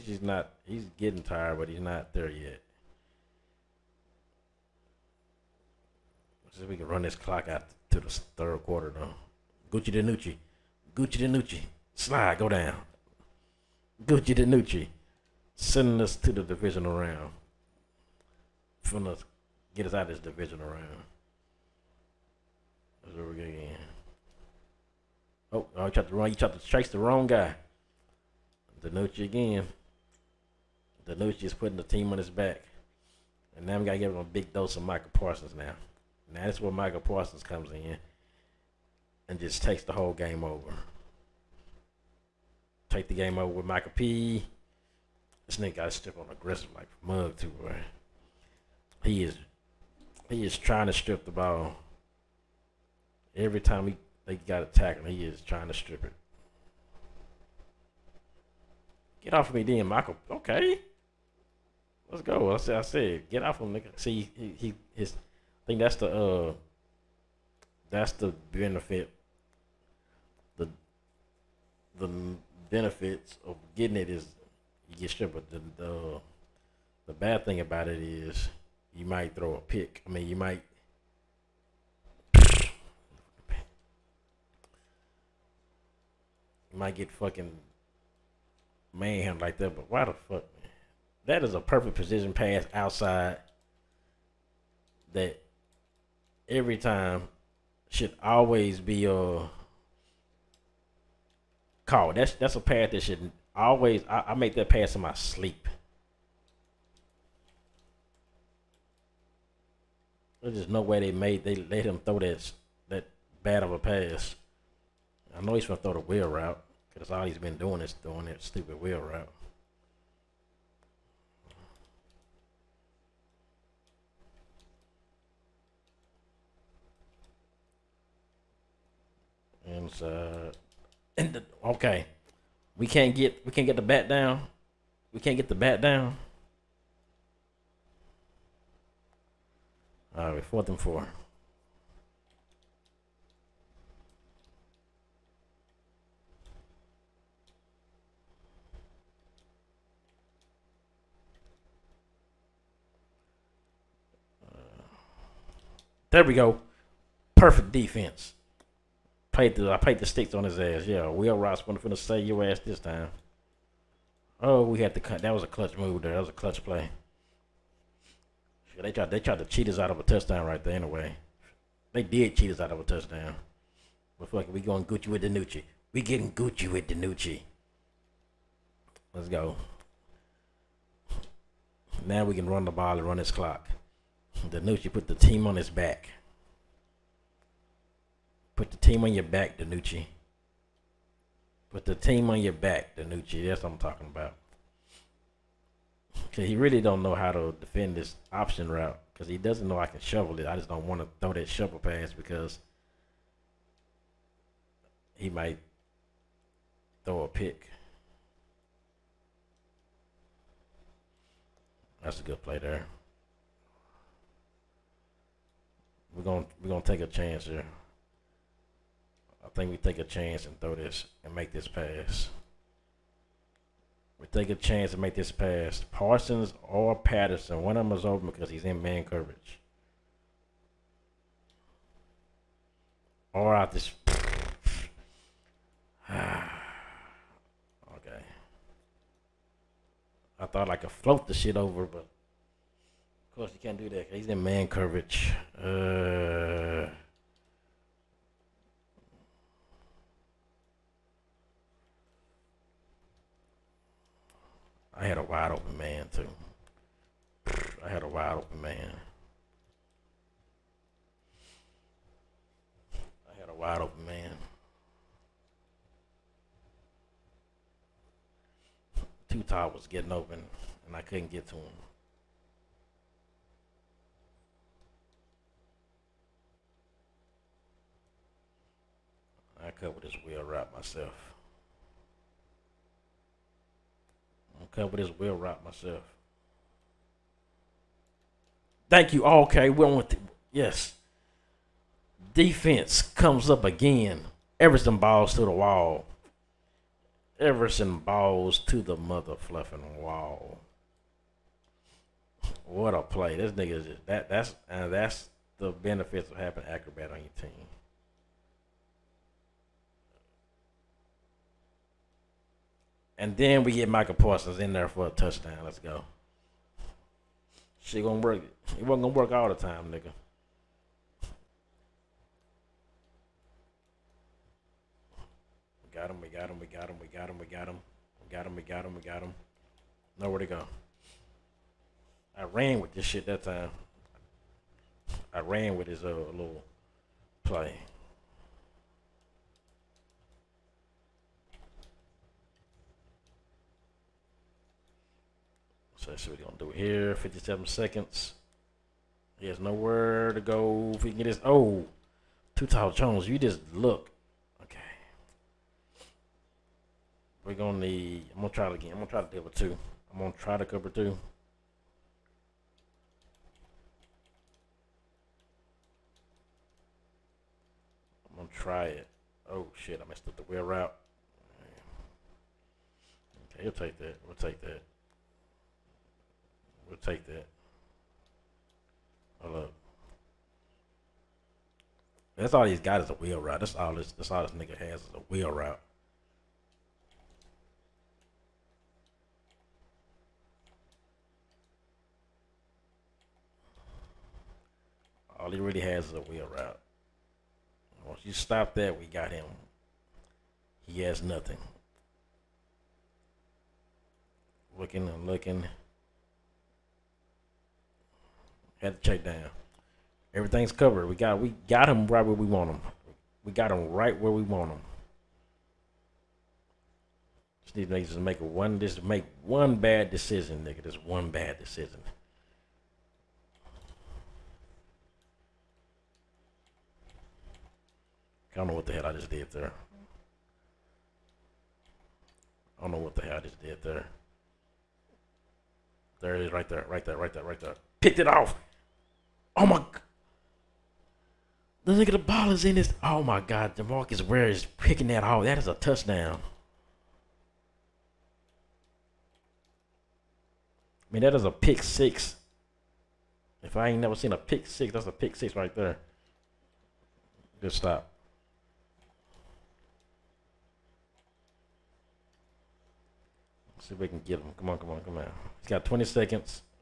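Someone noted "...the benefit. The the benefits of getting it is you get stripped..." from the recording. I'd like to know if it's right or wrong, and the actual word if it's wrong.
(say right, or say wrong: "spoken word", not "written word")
right.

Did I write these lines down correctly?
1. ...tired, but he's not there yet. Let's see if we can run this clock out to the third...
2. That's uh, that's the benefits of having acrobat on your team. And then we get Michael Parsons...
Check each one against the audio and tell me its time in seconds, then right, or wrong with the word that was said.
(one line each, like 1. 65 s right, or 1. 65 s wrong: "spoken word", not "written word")
1. 1 s right
2. 304 s right.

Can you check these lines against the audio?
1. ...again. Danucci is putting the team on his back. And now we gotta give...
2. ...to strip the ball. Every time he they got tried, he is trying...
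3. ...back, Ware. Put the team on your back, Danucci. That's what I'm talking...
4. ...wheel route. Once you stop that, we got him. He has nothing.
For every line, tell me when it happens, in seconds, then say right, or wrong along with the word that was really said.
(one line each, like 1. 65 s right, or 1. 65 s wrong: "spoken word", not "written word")
1. 29 s right
2. 50 s wrong: "attacked", not "tried"
3. 189 s wrong: "Danucci", not "Ware"
4. 396 s right.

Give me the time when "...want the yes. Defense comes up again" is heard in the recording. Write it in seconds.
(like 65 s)
289 s.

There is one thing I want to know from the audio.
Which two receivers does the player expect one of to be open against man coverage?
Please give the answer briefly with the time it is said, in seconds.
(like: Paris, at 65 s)
Parsons or Patterson, at 225 s.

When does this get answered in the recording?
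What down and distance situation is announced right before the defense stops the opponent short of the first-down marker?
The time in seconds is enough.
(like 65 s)
140 s.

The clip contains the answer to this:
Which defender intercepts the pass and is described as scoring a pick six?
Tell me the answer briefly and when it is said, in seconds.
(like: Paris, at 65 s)
Demarcus Ware, at 443 s.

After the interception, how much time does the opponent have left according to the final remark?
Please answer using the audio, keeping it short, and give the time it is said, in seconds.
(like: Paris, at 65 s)
20 seconds, at 465 s.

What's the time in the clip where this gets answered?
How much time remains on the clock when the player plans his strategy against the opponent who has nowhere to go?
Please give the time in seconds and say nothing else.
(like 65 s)
347 s.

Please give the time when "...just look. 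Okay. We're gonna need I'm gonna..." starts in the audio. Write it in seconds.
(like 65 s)
353 s.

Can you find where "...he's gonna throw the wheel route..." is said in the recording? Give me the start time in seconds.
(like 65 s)
115 s.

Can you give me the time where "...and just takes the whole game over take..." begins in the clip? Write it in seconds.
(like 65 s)
39 s.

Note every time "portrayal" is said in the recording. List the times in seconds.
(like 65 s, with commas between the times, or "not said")
not said.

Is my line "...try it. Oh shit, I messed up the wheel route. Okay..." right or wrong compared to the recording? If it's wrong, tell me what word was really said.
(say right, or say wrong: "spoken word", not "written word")
right.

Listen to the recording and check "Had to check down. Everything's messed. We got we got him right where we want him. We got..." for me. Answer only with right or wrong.
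wrong.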